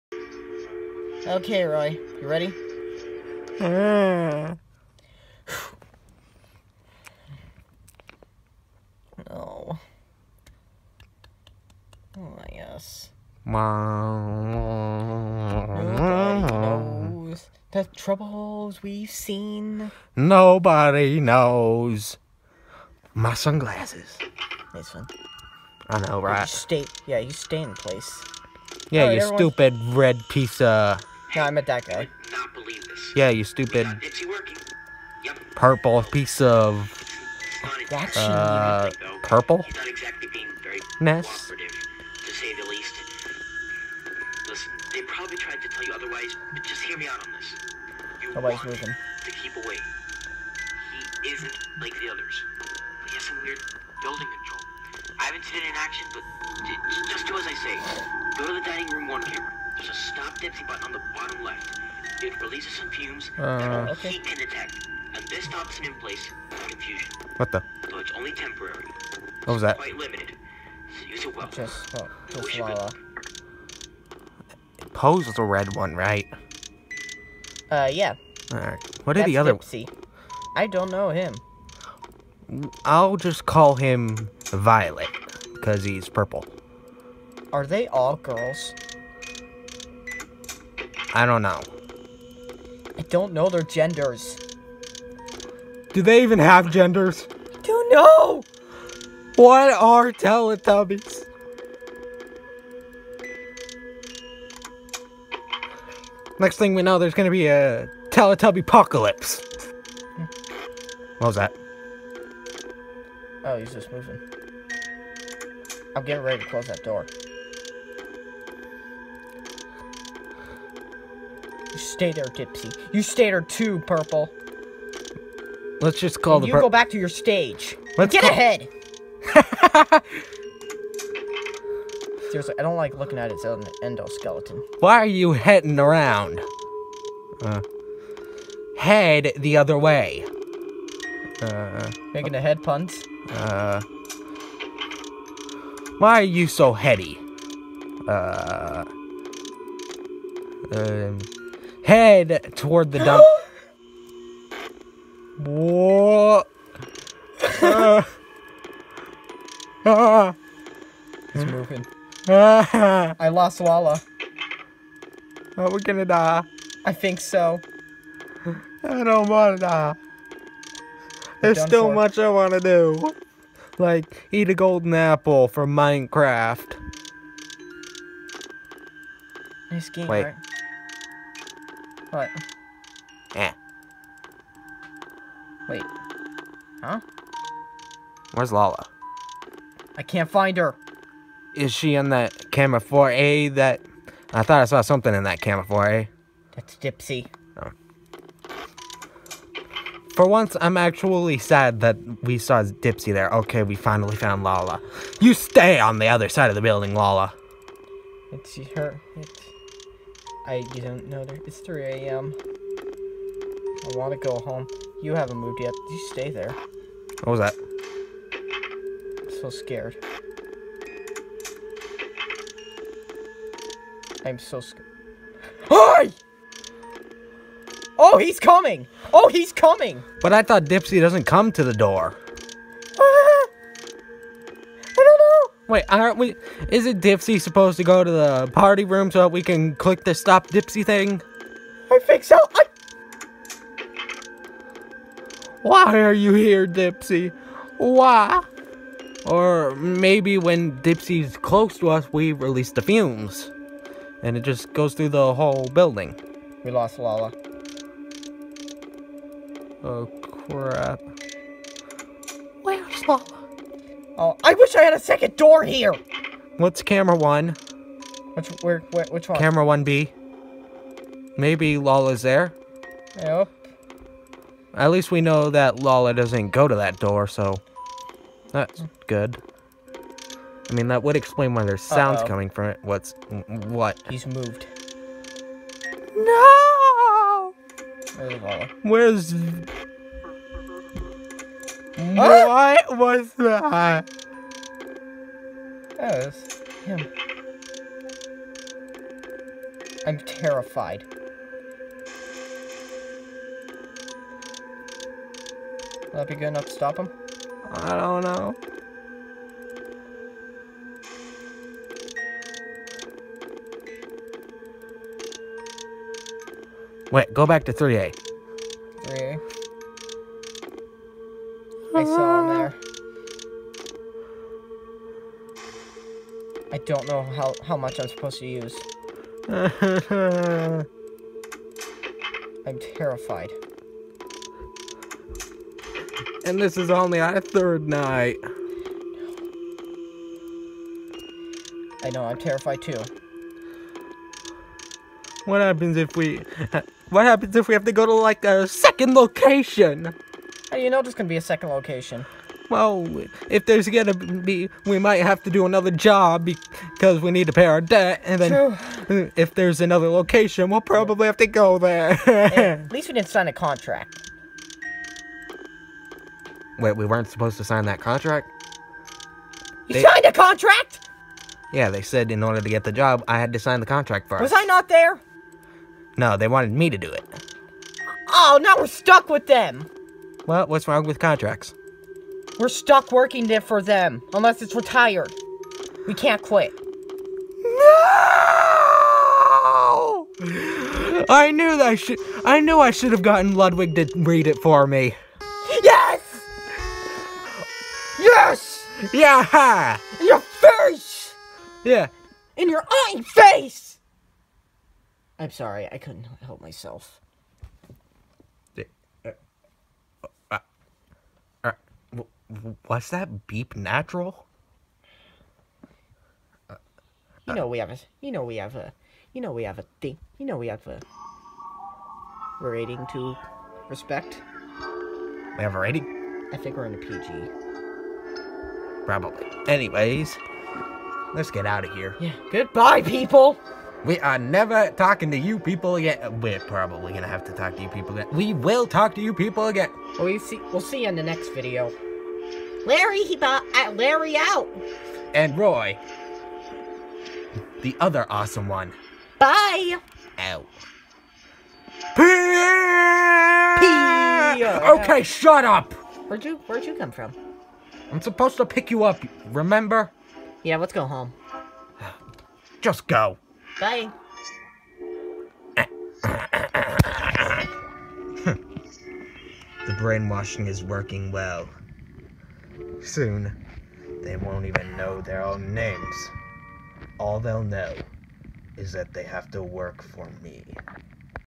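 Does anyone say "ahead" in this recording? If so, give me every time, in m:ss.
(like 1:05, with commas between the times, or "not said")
2:08.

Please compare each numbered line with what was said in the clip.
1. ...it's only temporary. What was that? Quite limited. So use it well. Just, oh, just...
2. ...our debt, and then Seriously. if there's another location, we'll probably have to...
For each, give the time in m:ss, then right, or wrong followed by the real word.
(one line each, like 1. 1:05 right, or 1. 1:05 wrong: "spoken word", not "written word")
1. 1:07 right
2. 5:57 wrong: "True", not "Seriously".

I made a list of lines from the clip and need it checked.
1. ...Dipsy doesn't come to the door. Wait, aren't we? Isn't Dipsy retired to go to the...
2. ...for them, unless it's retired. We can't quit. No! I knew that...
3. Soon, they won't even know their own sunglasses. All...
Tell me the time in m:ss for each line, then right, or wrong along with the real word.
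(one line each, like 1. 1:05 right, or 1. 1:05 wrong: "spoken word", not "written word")
1. 3:50 wrong: "supposed", not "retired"
2. 6:23 right
3. 7:53 wrong: "names", not "sunglasses".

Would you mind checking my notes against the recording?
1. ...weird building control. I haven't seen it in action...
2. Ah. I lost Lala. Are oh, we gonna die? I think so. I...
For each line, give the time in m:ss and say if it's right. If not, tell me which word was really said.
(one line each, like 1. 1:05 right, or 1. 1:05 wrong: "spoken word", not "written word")
1. 0:53 right
2. 2:42 right.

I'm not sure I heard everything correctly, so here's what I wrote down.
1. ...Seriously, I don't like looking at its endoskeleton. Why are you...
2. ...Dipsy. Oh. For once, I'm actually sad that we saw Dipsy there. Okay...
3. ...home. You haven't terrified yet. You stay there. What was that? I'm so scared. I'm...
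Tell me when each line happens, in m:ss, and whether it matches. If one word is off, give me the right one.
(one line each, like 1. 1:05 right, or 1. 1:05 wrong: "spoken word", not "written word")
1. 2:12 right
2. 3:16 right
3. 3:34 wrong: "moved", not "terrified".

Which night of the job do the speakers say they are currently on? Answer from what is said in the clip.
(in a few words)
third night.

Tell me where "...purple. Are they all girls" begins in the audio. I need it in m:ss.
1:26.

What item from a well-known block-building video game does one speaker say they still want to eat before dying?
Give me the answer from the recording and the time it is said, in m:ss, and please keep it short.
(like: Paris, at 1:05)
golden apple, at 2:54.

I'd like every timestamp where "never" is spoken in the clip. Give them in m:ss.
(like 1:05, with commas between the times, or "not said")
7:14.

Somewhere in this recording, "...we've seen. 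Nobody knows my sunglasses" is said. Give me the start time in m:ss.
0:18.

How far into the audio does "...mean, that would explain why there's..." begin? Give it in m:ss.
4:40.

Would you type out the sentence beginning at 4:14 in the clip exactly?
And it just goes through the whole building.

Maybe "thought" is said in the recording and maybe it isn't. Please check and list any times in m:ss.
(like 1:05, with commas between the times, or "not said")
3:14, 3:50.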